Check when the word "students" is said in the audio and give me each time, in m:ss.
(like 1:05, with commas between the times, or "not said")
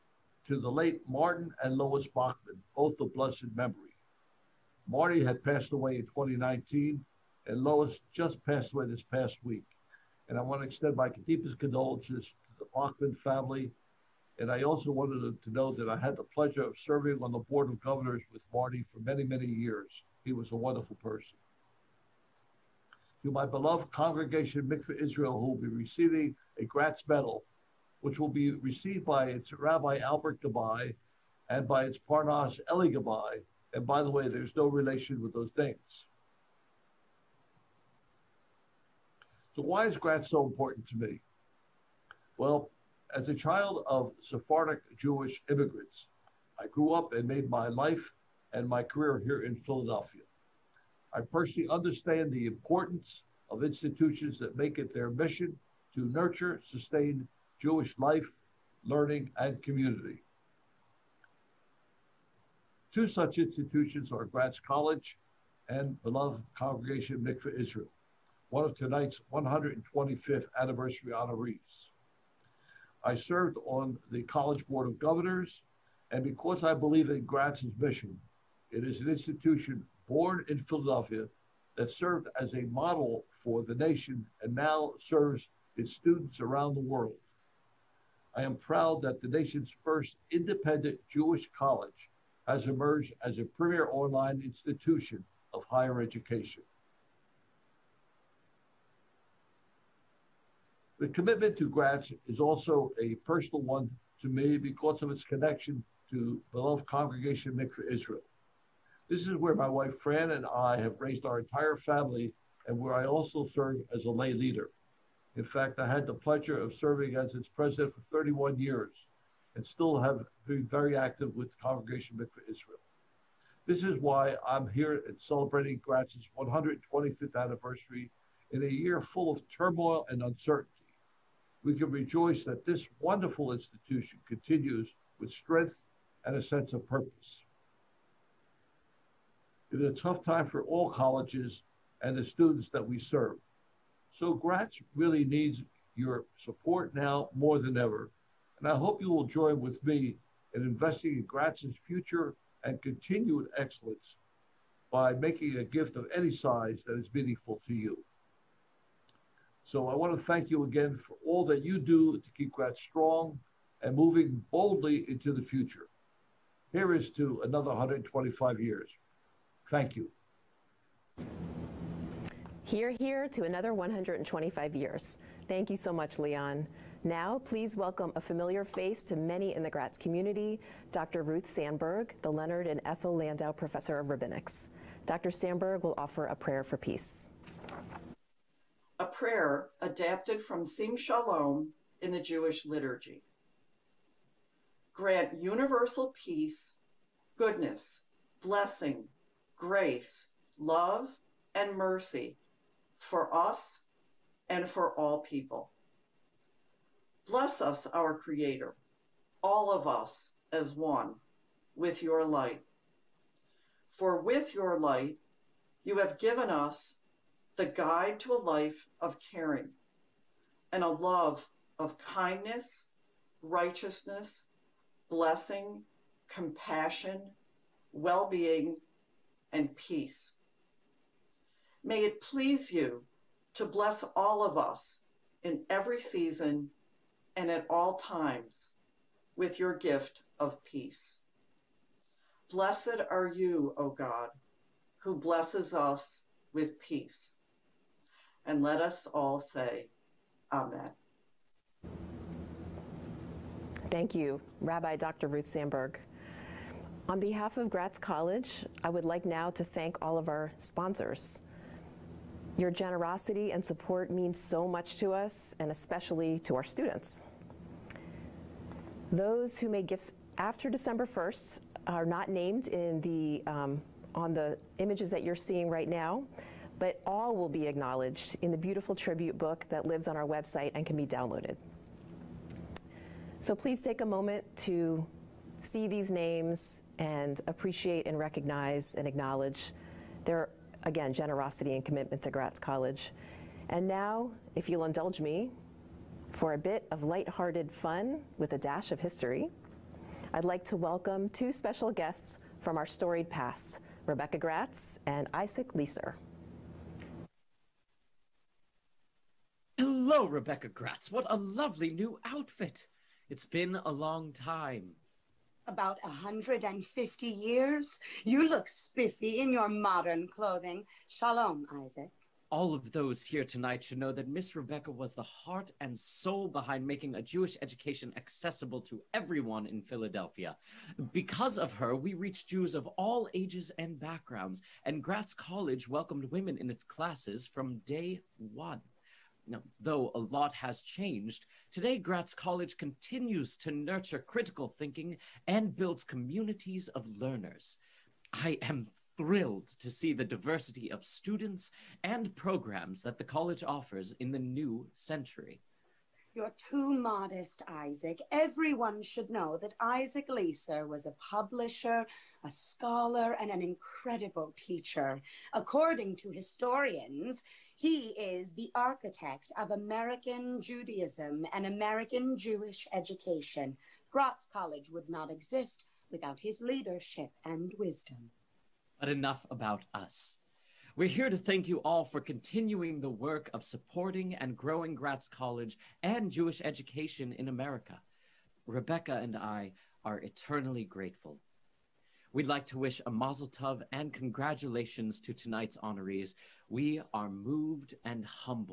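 1:25, 2:22, 4:26, 5:51.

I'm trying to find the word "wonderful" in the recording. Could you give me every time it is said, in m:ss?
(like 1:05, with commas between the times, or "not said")
0:20, 2:13.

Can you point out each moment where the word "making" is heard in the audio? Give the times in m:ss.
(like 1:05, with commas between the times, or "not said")
2:35, 5:26.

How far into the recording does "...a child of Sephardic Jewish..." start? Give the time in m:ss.
0:43.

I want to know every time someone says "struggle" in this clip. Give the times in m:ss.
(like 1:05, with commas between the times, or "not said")
not said.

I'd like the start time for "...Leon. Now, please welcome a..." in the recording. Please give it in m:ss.
2:56.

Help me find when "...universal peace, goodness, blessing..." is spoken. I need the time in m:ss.
3:15.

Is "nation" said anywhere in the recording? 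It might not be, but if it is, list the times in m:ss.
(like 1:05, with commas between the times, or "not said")
1:23, 1:29.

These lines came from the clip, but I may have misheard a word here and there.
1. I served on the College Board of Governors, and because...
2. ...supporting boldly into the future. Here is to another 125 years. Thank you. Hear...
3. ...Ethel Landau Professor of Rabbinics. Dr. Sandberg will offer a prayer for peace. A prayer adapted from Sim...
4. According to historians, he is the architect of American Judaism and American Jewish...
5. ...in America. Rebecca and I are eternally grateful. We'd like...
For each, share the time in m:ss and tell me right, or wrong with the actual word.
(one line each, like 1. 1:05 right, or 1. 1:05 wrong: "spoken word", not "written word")
1. 1:13 right
2. 2:43 wrong: "moving", not "supporting"
3. 3:02 right
4. 6:05 right
5. 6:27 right.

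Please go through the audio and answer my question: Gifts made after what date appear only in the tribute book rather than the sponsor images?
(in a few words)
December 1st.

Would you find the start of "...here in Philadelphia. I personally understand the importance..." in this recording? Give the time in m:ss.
0:49.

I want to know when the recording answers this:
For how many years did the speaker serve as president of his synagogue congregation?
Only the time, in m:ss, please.
1:58.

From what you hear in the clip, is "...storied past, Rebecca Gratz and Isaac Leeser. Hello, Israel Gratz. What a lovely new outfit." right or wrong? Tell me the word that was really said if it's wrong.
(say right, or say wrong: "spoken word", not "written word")
wrong: "Rebecca", not "Israel".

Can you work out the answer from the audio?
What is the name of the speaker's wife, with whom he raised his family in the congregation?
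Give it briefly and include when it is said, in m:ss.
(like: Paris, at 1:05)
Fran, at 1:49.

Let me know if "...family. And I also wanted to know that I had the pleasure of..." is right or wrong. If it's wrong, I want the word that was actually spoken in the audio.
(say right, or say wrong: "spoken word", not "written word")
right.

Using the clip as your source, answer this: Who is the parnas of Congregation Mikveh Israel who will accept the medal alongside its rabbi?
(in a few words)
Eli Gabai.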